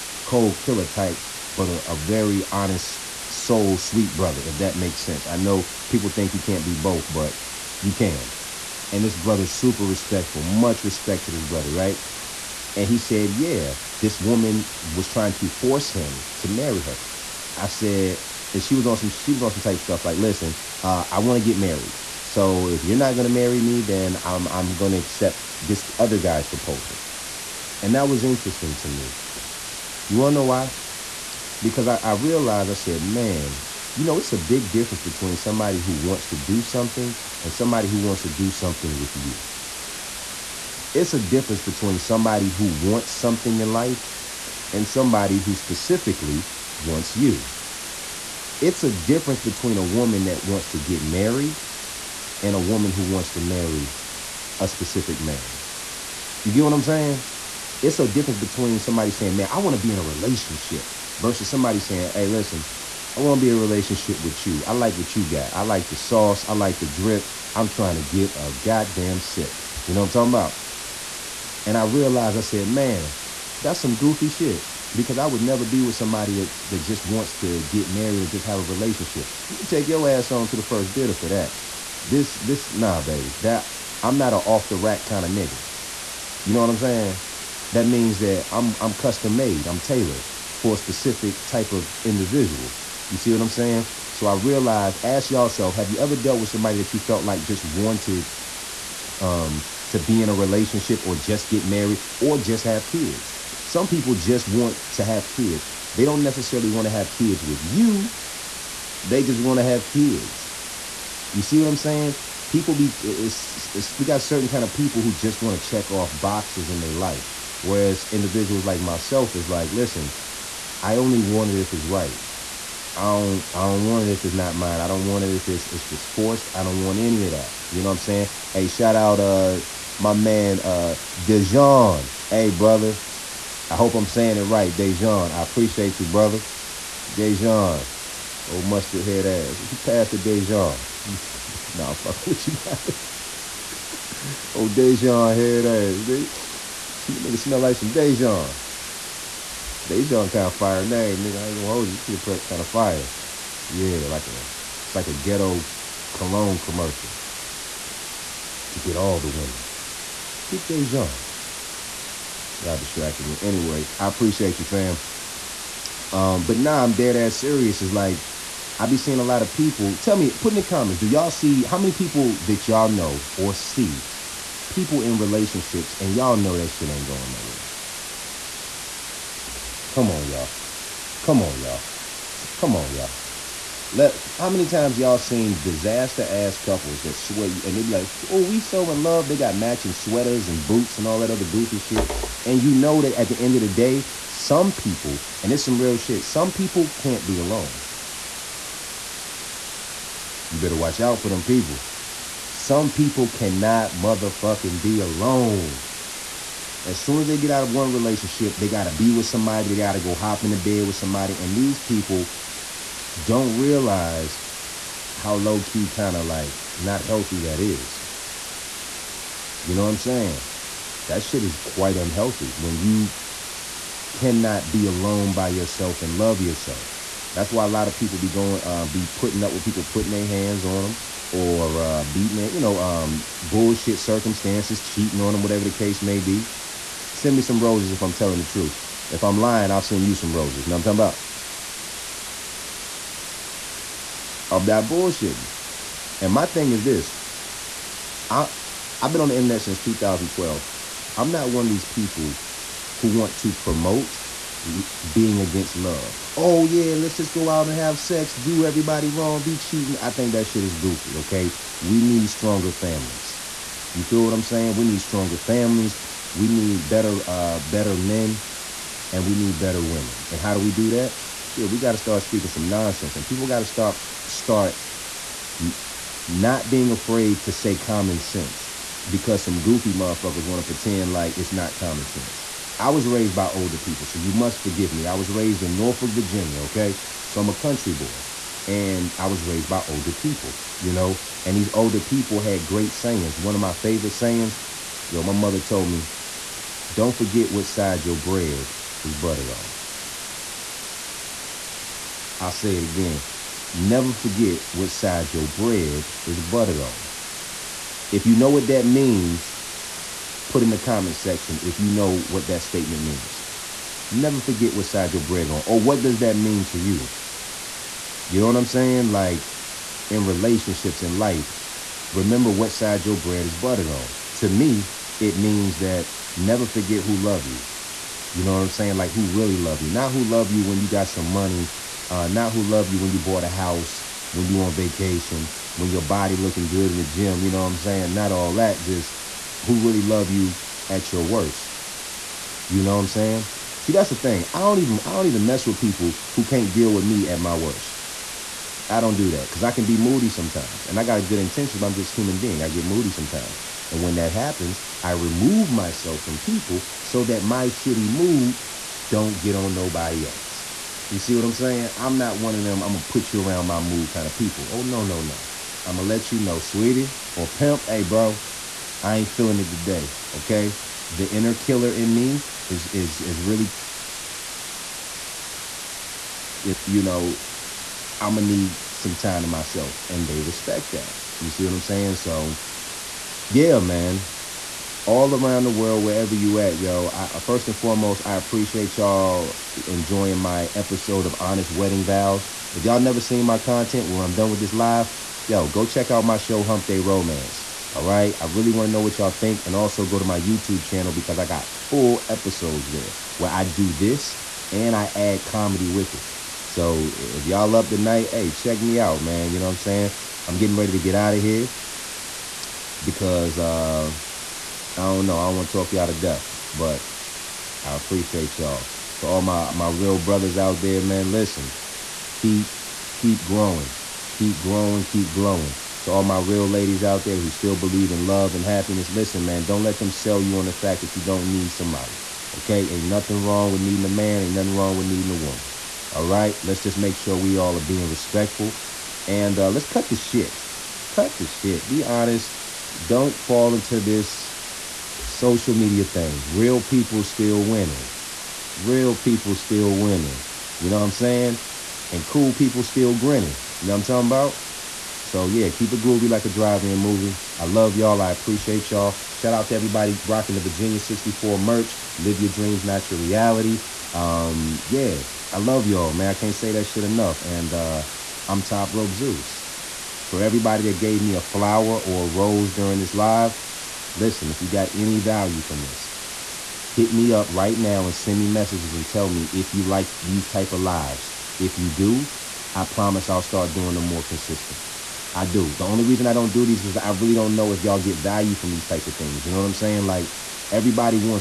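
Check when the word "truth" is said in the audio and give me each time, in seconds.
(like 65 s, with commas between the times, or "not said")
238 s.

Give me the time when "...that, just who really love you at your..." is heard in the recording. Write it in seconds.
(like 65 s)
338 s.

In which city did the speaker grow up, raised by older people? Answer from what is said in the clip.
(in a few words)
Norfolk, Virginia.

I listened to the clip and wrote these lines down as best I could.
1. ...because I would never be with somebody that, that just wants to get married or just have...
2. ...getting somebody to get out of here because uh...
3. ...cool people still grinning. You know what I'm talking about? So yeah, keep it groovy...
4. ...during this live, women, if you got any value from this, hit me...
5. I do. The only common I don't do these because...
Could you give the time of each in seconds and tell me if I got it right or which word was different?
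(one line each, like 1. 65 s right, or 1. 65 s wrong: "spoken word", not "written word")
1. 74 s right
2. 410 s wrong: "ready", not "somebody"
3. 452 s right
4. 472 s wrong: "listen", not "women"
5. 485 s wrong: "reason", not "common".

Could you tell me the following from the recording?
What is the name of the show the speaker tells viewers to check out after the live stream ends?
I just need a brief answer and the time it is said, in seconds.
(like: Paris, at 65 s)
Hump Day Romance, at 396 s.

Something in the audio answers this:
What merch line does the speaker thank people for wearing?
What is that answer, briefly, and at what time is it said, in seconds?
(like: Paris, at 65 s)
Virginia 64, at 460 s.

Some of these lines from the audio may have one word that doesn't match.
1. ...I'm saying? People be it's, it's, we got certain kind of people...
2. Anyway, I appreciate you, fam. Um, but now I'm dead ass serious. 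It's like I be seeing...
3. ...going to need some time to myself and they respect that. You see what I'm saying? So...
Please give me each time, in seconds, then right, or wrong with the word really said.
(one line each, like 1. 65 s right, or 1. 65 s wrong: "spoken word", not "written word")
1. 111 s right
2. 163 s right
3. 378 s right.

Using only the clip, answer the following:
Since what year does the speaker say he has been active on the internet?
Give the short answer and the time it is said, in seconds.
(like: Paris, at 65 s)
2012, at 249 s.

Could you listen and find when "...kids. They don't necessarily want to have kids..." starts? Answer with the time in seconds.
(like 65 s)
105 s.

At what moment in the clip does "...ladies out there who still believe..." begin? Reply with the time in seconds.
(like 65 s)
426 s.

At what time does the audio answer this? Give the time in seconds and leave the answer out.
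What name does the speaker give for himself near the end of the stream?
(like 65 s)
468 s.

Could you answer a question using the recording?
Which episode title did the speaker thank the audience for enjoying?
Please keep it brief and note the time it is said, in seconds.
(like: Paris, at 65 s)
Honest Wedding Vows, at 391 s.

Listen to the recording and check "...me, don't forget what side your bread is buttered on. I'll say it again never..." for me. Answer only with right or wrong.
right.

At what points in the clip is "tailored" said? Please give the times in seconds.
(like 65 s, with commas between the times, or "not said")
89 s.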